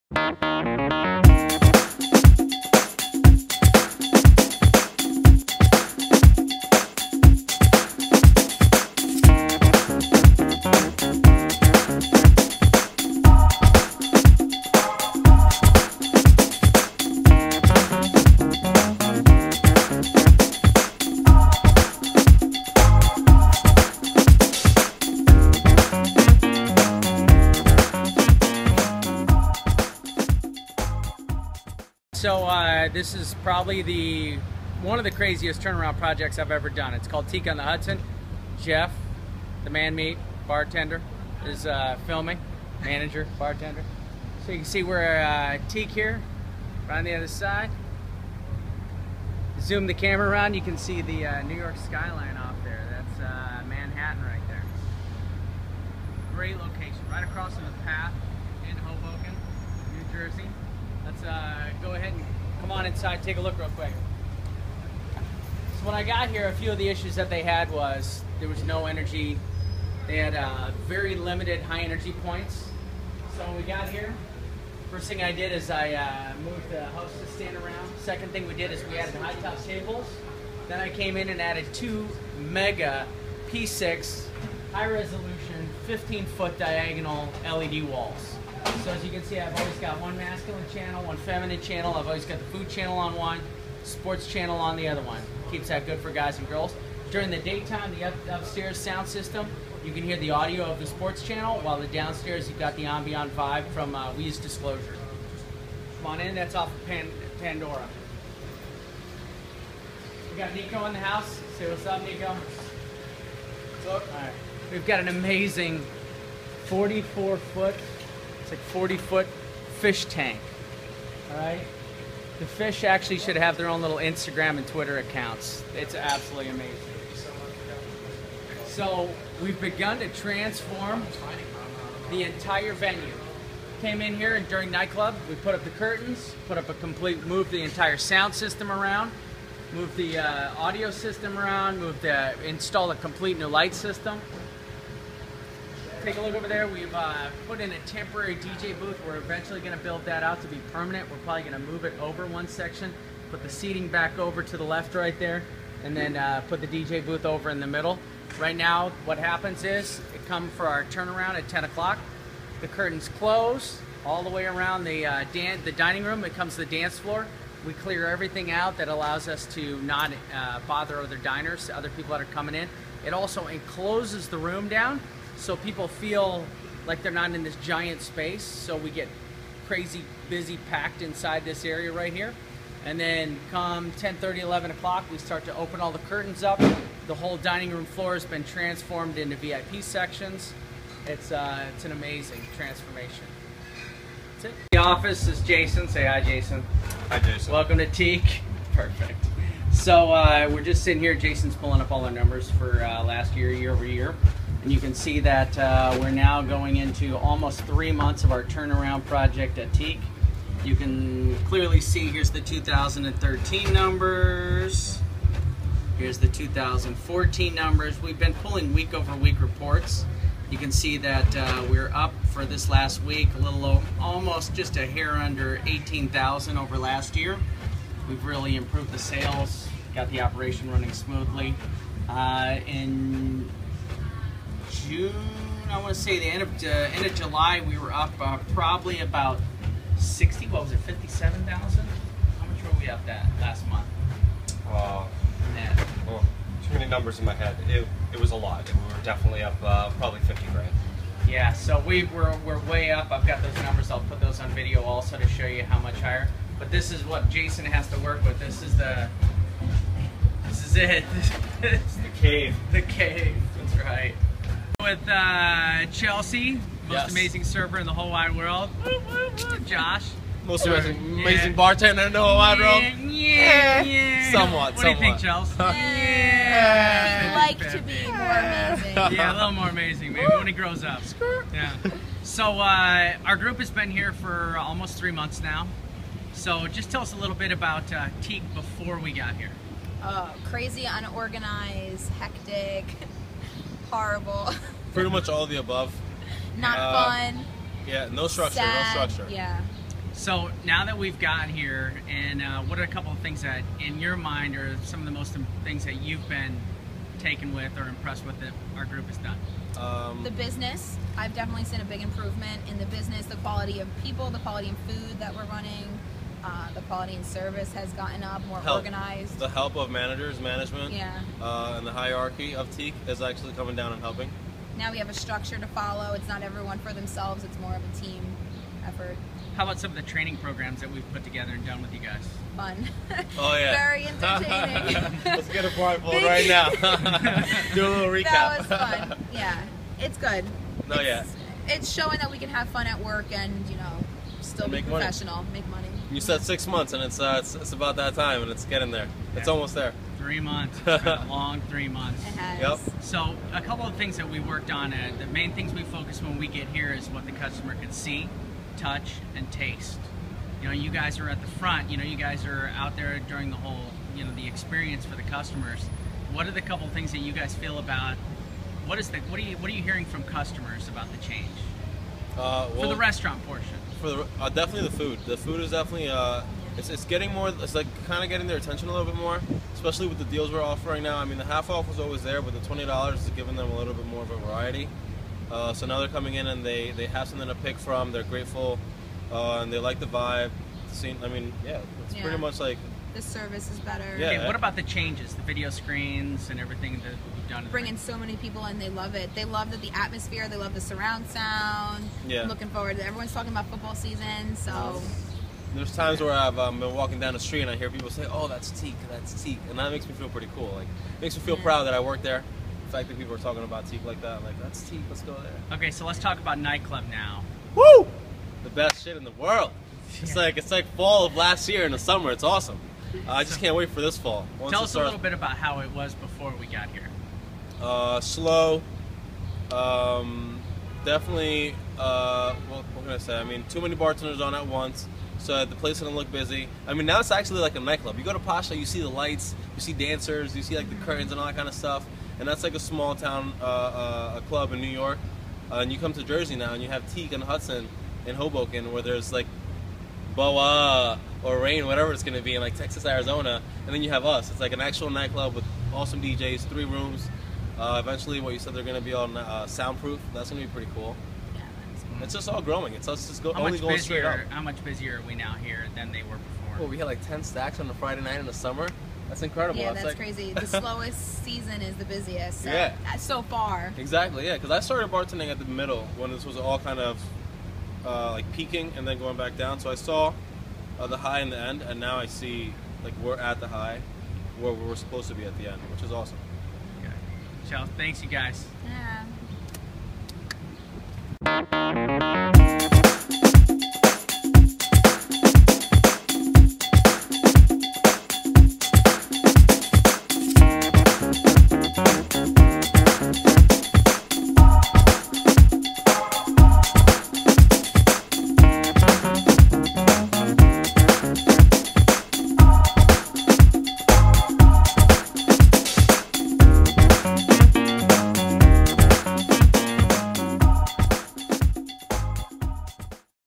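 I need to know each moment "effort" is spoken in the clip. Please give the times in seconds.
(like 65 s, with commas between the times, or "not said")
328 s.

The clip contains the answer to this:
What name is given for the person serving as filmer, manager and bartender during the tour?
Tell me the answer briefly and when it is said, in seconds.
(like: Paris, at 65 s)
Jeff, at 38 s.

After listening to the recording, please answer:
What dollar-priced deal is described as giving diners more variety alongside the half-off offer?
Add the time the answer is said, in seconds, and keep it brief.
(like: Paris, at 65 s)
$20, at 382 s.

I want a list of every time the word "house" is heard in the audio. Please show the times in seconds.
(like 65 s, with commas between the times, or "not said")
76 s, 110 s.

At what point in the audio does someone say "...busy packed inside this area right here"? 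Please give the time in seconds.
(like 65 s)
180 s.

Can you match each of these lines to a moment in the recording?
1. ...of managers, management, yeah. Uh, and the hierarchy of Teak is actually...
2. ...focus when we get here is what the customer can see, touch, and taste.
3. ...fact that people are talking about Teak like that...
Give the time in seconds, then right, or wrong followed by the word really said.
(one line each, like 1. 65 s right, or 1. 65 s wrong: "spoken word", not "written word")
1. 319 s right
2. 355 s right
3. 412 s right.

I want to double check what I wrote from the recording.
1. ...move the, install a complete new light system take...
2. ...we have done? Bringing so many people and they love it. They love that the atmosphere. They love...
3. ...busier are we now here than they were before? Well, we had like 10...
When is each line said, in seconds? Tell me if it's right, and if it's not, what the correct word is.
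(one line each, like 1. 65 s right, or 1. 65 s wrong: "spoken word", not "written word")
1. 141 s right
2. 397 s right
3. 464 s right.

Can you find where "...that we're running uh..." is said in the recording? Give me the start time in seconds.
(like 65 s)
315 s.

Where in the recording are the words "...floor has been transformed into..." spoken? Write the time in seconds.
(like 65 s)
187 s.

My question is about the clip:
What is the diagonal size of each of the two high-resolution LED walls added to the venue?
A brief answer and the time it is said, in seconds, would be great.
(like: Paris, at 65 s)
15 feet, at 85 s.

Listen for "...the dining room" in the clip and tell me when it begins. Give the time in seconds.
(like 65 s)
165 s.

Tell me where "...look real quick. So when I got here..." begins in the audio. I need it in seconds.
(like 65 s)
63 s.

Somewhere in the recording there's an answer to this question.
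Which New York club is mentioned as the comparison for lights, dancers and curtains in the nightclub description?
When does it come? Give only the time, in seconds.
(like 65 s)
438 s.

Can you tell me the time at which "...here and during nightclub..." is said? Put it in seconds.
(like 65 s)
134 s.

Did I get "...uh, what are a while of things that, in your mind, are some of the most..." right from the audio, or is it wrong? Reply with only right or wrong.
wrong.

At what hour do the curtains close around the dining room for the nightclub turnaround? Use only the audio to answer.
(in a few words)
10 o'clock.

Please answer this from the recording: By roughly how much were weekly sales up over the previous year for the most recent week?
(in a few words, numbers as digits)
18,000.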